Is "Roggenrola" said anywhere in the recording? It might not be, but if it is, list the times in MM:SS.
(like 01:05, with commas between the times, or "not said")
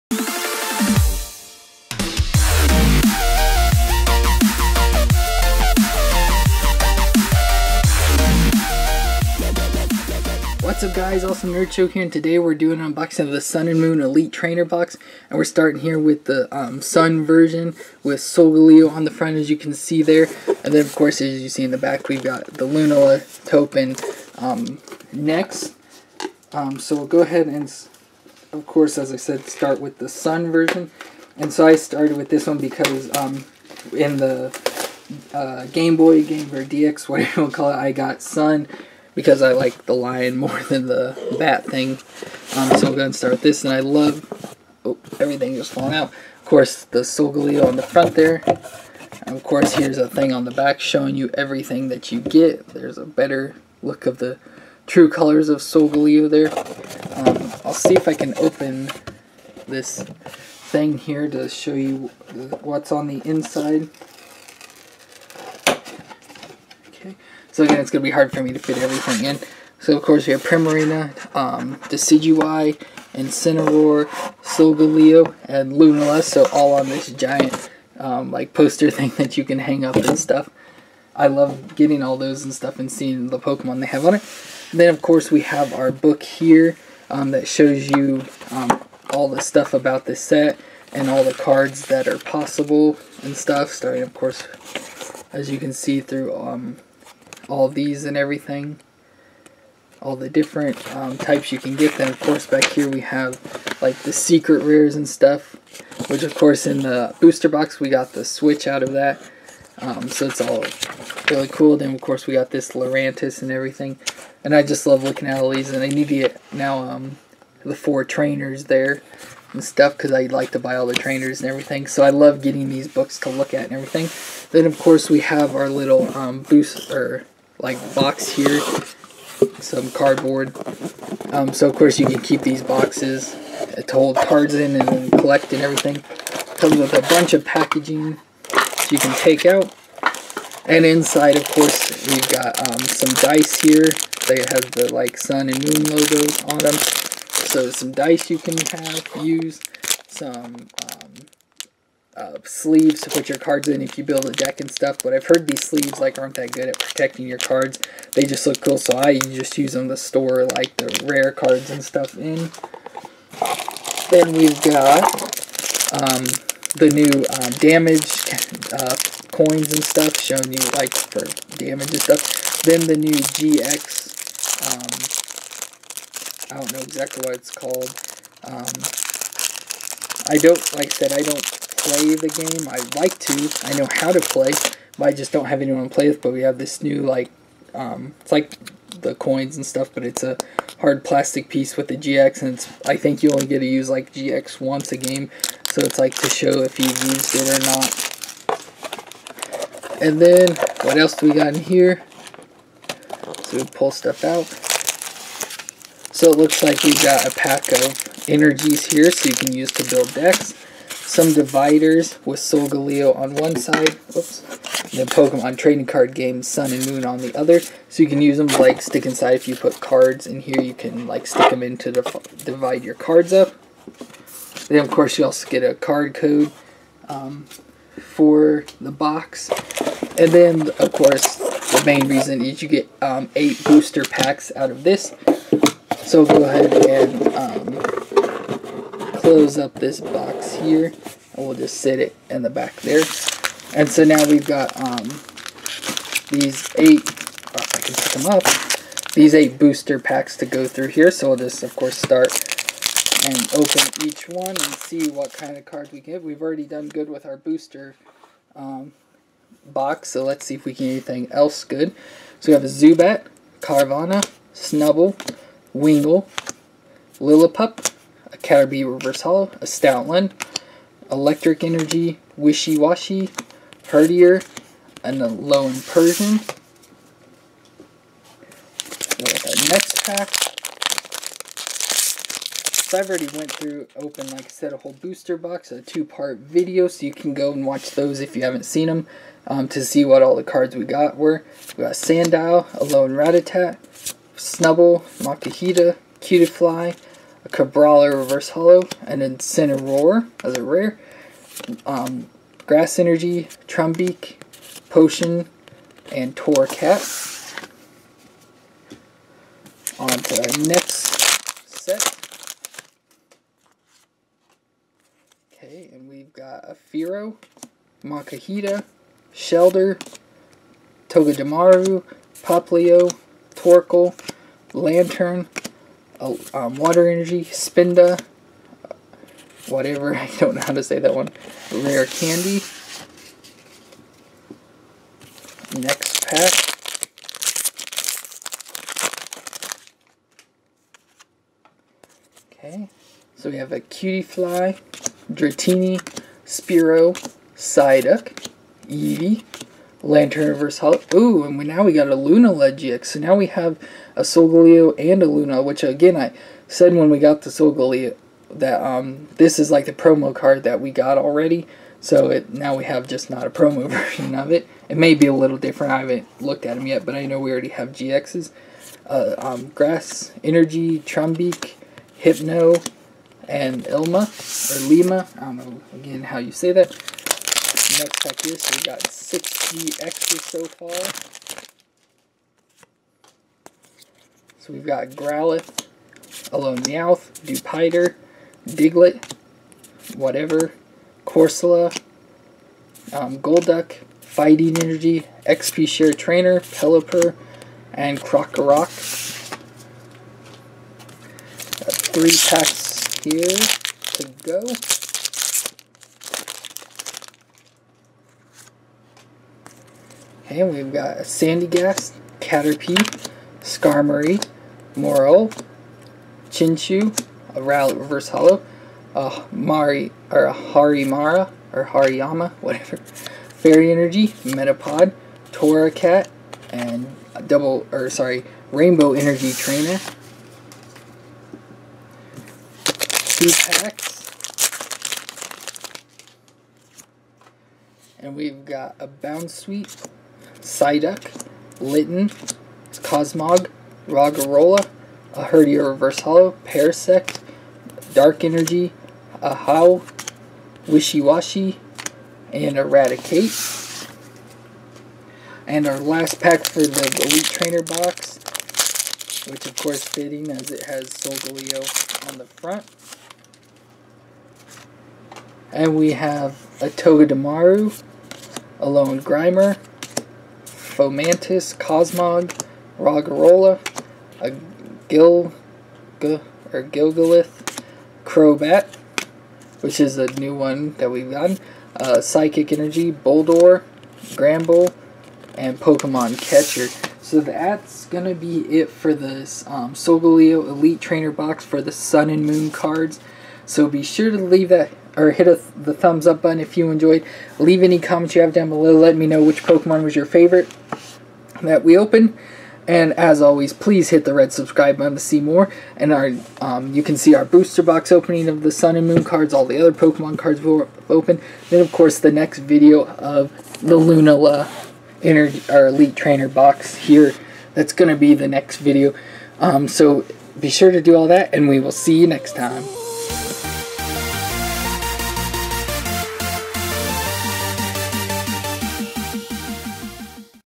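07:24, 07:52.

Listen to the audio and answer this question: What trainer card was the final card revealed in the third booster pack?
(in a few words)
Rare Candy.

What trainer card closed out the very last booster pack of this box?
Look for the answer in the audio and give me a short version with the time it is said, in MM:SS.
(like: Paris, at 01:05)
Pokemon Catcher, at 08:05.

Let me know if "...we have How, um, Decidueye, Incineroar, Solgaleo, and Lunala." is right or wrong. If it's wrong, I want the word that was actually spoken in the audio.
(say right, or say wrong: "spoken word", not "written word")
wrong: "Primarina", not "How".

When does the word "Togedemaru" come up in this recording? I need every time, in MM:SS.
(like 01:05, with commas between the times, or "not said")
05:21, 07:46.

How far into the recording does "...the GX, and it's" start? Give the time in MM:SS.
03:11.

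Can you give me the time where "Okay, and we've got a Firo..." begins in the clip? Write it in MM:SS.
05:15.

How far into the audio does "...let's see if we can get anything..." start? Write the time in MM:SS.
04:20.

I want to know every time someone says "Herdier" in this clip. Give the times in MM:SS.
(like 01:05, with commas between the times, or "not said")
04:33, 07:25.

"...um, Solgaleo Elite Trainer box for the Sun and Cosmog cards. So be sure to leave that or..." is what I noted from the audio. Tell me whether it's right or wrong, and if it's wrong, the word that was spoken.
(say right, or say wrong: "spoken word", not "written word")
wrong: "Moon", not "Cosmog".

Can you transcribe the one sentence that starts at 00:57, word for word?
Um, I'll see if I can open this thing here to show you what's on the inside.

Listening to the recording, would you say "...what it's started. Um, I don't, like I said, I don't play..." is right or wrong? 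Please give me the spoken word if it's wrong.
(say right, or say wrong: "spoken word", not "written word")
wrong: "called", not "started".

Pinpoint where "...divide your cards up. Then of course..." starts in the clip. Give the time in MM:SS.
03:41.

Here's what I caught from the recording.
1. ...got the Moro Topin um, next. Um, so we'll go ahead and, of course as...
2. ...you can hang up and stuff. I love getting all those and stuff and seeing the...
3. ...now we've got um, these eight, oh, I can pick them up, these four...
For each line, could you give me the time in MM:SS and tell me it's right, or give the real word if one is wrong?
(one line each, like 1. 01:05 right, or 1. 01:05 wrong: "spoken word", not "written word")
1. 00:22 wrong: "Lunala", not "Moro"
2. 01:19 right
3. 04:04 wrong: "eight", not "four".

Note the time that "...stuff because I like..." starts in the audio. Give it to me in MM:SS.
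01:59.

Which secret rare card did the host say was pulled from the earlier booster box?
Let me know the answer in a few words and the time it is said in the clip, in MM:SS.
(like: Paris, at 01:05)
the Switch, at 01:48.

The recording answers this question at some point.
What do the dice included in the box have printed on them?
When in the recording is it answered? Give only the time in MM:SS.
02:25.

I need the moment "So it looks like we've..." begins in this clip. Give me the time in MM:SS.
03:26.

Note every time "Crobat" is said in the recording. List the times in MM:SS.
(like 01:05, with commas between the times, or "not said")
07:58.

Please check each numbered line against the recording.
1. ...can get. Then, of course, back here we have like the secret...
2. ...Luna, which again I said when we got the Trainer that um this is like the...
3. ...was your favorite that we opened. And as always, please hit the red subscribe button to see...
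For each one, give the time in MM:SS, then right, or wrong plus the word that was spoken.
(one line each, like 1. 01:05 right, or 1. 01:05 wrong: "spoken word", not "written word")
1. 01:41 right
2. 05:55 wrong: "Solgaleo", not "Trainer"
3. 08:20 right.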